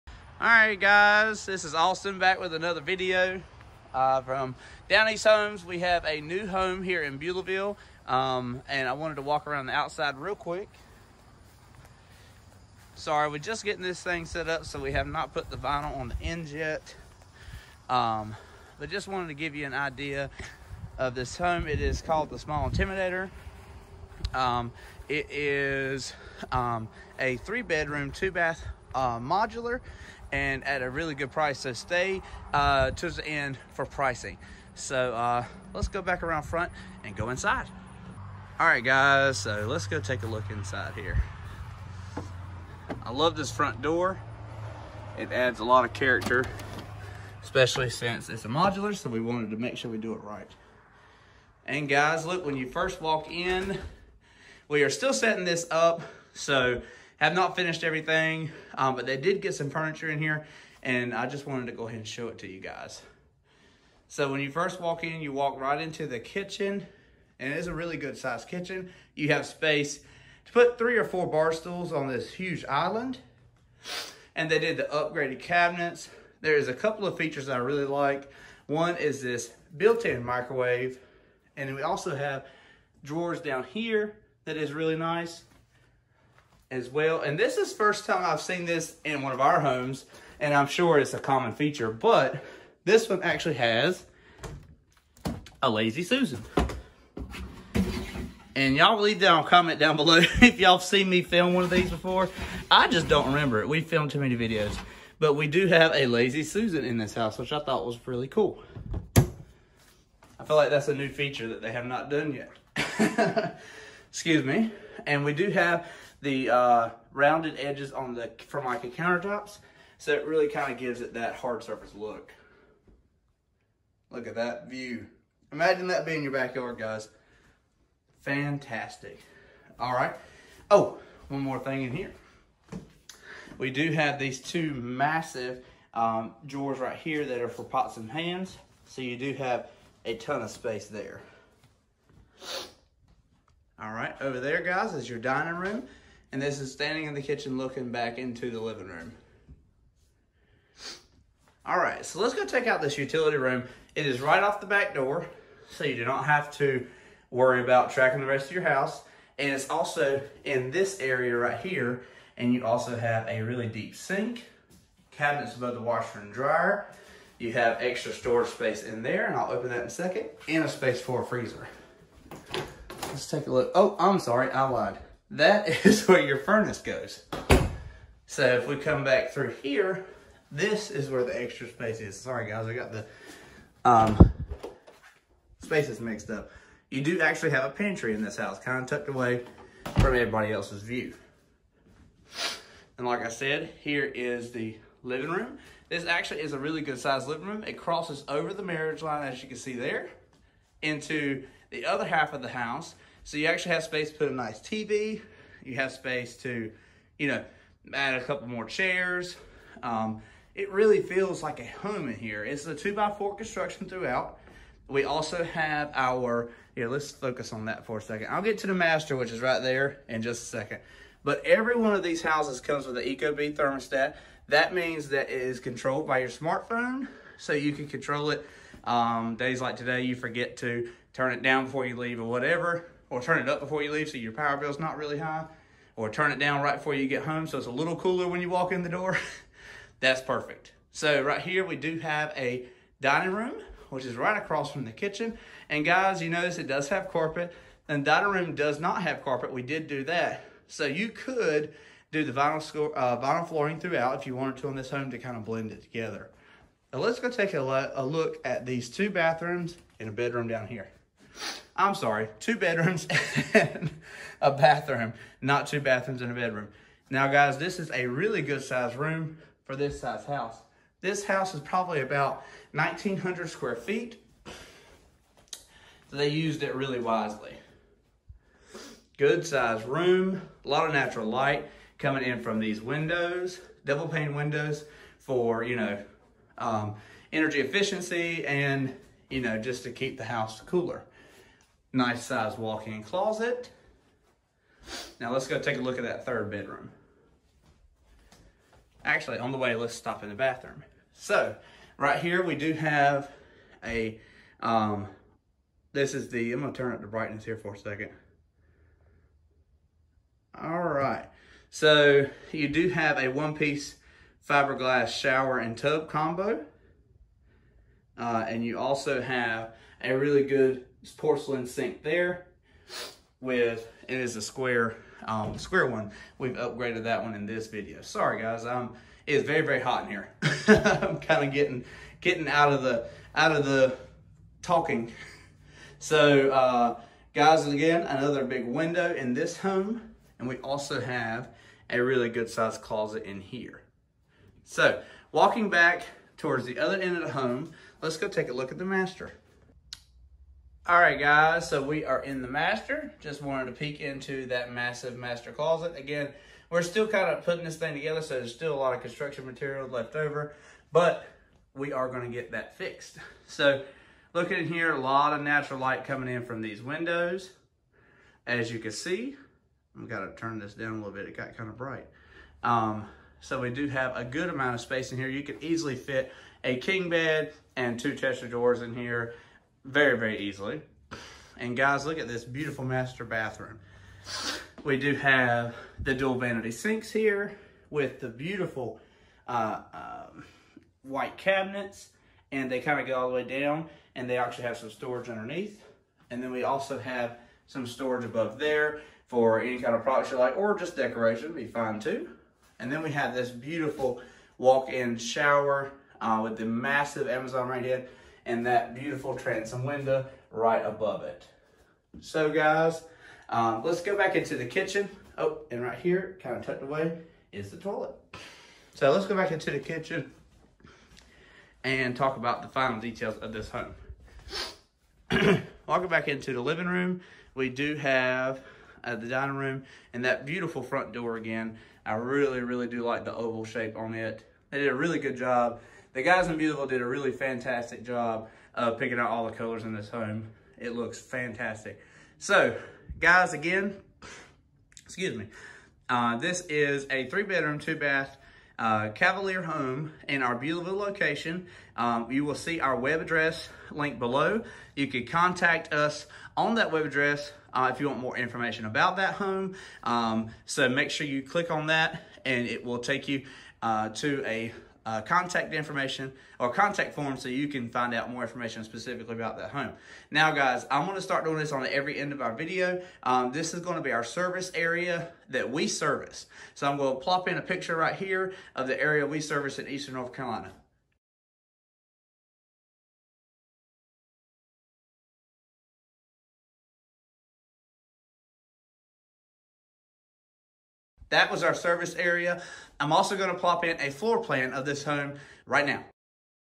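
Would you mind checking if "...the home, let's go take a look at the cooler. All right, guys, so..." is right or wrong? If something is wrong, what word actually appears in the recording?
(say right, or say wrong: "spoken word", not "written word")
wrong: "master", not "cooler".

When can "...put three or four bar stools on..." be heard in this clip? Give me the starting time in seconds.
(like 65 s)
70 s.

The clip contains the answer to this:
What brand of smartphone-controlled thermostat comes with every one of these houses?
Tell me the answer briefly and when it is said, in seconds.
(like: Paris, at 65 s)
Ecobee, at 223 s.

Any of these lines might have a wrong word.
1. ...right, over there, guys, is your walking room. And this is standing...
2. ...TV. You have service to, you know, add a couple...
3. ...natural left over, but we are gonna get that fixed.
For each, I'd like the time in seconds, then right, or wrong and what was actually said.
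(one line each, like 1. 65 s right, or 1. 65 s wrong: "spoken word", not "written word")
1. 143 s wrong: "dining", not "walking"
2. 204 s wrong: "space", not "service"
3. 359 s wrong: "material", not "natural".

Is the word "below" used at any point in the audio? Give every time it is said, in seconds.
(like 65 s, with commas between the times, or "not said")
99 s, 454 s.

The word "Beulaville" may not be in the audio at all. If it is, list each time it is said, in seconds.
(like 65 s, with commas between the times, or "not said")
7 s, 436 s, 450 s.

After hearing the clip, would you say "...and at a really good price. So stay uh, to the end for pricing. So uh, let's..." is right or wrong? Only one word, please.
right.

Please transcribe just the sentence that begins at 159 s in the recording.
And it's also in this area right here, and you also have a really deep sink, cabinets above the washer and dryer.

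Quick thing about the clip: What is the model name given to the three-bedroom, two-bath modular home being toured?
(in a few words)
Small Intimidator.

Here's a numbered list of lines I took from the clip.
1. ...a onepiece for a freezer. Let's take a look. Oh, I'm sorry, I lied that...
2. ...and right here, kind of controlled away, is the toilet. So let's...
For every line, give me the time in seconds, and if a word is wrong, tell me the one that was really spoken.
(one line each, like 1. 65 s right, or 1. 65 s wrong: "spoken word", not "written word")
1. 170 s wrong: "space", not "onepiece"
2. 415 s wrong: "tucked", not "controlled".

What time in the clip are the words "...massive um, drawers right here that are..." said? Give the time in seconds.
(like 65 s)
134 s.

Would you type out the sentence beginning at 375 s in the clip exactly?
You could easily fit a king bed and two chest of drawers in here very, very easily.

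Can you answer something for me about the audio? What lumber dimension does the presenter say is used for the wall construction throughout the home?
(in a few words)
2x4.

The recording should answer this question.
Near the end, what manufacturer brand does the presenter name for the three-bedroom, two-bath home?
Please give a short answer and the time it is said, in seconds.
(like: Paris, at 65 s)
Cavalier, at 449 s.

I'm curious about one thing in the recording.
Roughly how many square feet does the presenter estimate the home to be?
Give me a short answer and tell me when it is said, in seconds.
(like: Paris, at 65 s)
1900, at 272 s.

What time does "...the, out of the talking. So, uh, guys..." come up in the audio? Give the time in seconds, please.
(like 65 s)
332 s.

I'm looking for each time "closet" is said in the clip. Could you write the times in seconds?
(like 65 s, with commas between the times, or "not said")
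293 s, 342 s, 355 s.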